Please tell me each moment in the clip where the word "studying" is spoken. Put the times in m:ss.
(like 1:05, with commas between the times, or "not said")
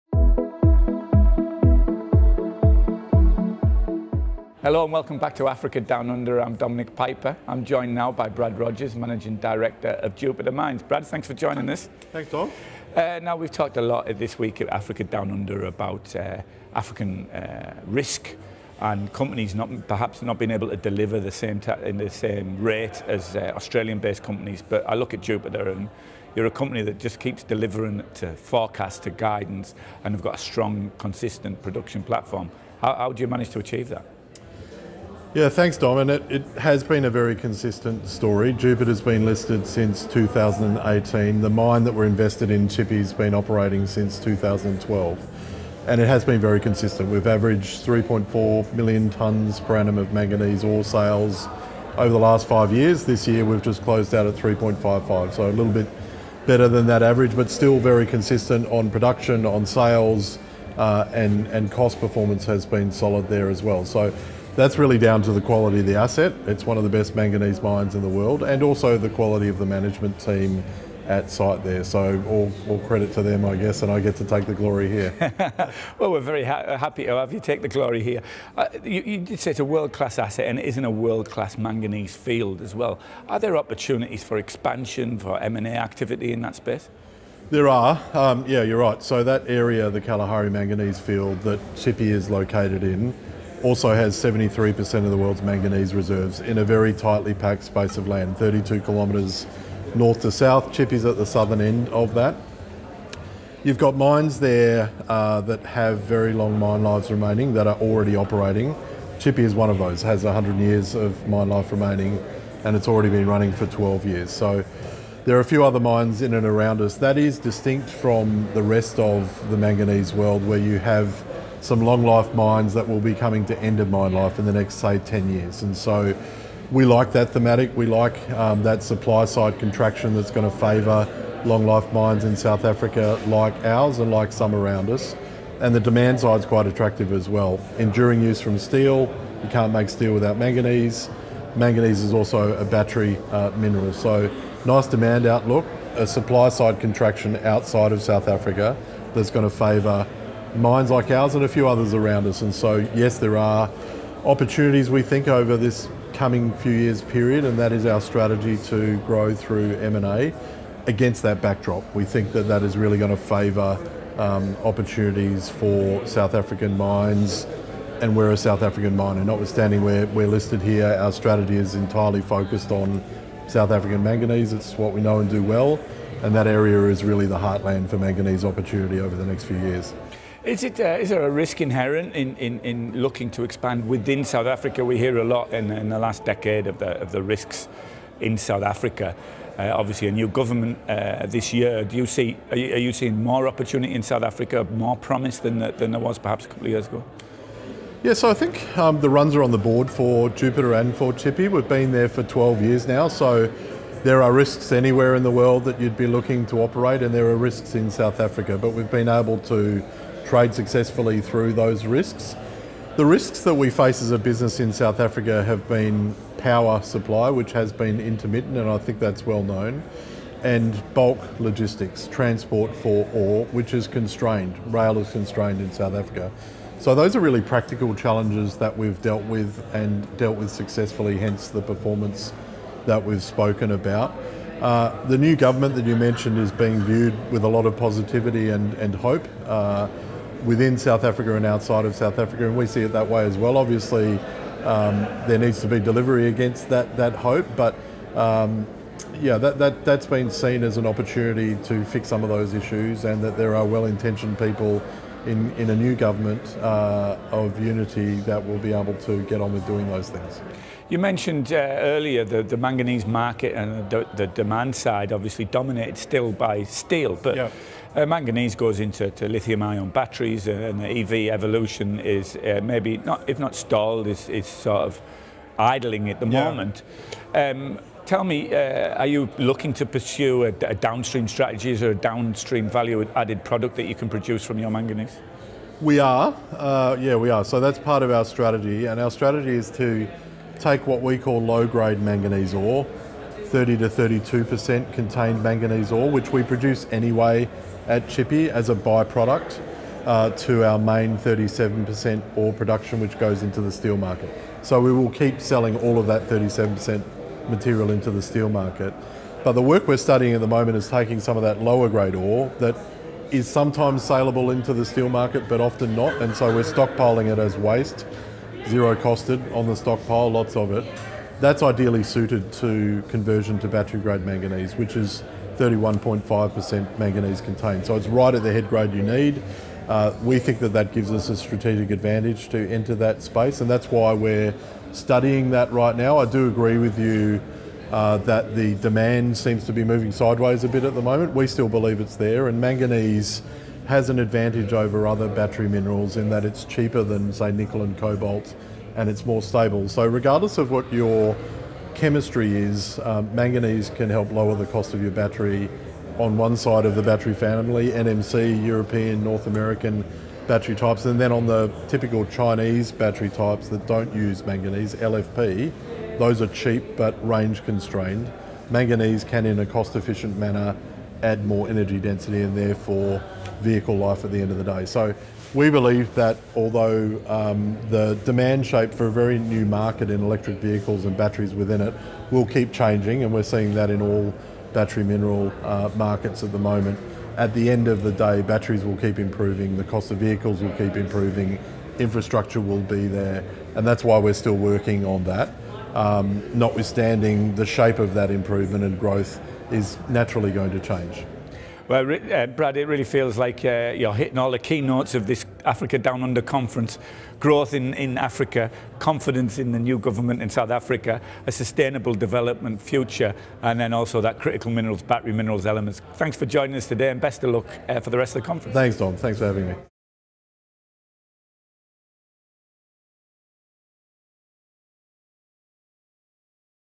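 5:09, 5:34.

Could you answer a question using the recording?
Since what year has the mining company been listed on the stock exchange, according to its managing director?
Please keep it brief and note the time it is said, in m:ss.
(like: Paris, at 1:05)
2018, at 0:40.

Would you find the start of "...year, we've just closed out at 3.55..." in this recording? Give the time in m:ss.
0:53.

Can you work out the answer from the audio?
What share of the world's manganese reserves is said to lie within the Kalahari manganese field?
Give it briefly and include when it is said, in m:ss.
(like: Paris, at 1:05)
73%, at 1:34.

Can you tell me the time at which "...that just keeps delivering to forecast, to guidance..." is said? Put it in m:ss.
0:26.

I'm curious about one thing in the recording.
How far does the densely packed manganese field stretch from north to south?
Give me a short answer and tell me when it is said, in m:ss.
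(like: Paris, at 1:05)
32 kilometres, at 1:38.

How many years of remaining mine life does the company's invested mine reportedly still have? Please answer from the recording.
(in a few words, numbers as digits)
100 years.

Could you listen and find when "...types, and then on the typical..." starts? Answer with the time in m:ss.
6:00.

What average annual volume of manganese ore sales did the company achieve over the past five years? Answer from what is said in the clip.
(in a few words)
3.4 million tonnes.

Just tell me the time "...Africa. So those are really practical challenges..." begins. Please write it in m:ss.
3:45.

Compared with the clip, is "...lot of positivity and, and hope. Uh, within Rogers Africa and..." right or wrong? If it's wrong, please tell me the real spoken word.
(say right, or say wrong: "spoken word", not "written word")
wrong: "South", not "Rogers".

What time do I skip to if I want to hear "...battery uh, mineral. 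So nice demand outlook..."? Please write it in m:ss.
2:22.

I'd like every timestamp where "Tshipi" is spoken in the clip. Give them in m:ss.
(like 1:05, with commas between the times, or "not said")
1:31, 1:49, 3:21, 4:58.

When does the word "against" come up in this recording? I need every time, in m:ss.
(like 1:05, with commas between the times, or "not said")
2:40, 4:06.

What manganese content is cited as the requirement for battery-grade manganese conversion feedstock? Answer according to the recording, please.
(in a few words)
31.5%.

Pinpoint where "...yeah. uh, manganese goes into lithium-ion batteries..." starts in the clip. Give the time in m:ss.
4:27.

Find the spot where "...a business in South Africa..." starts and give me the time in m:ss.
3:34.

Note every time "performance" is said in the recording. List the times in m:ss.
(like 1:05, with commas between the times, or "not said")
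1:02, 3:51.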